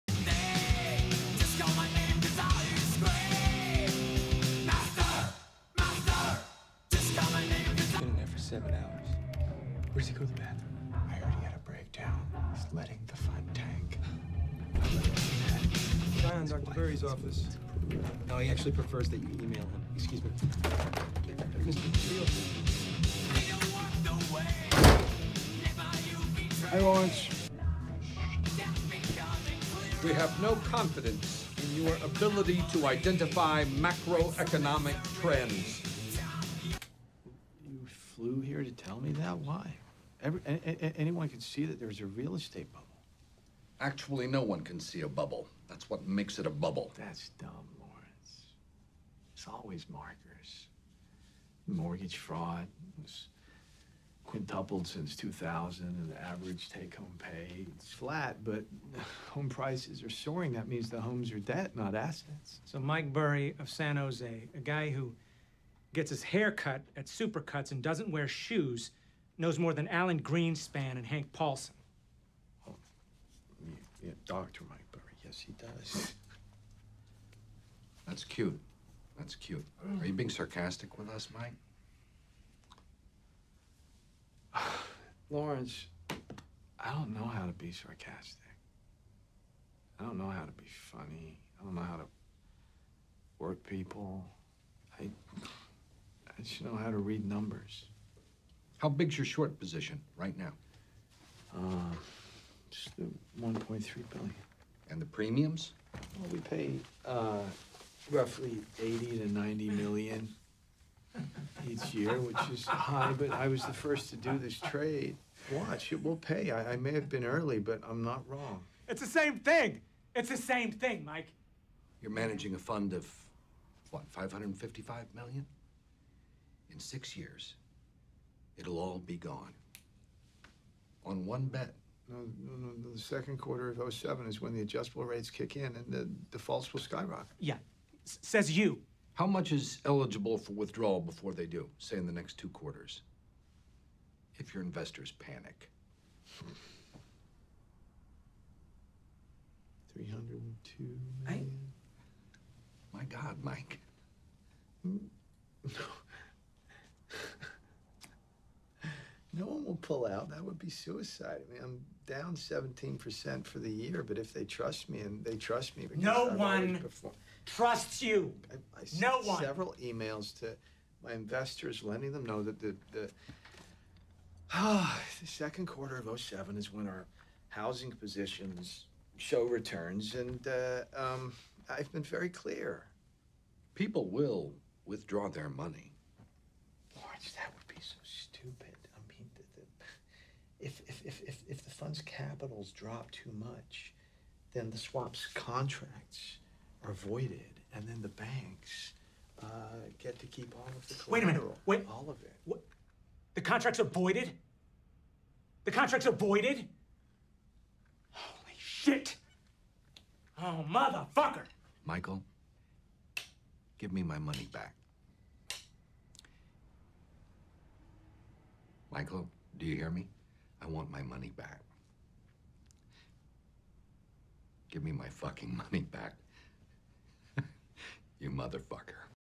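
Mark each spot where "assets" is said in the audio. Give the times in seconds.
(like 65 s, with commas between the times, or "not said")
61 s.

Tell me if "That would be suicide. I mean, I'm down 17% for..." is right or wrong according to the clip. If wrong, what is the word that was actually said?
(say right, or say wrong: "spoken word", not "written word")
right.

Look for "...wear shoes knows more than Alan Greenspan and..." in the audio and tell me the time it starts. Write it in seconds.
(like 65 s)
68 s.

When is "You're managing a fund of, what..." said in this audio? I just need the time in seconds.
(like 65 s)
122 s.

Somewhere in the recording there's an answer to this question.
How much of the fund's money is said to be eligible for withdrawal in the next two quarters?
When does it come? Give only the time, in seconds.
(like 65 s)
149 s.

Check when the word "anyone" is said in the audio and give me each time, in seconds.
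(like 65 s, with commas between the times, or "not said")
40 s.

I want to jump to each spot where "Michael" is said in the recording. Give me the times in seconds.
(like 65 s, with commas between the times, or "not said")
211 s, 218 s.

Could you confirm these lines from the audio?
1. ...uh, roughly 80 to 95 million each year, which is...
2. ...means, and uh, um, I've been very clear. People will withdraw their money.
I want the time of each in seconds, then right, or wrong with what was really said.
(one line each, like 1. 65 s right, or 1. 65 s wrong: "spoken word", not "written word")
1. 107 s wrong: "90", not "95"
2. 179 s wrong: "returns", not "means".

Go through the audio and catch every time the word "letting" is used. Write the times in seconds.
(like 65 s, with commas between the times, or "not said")
12 s, 171 s.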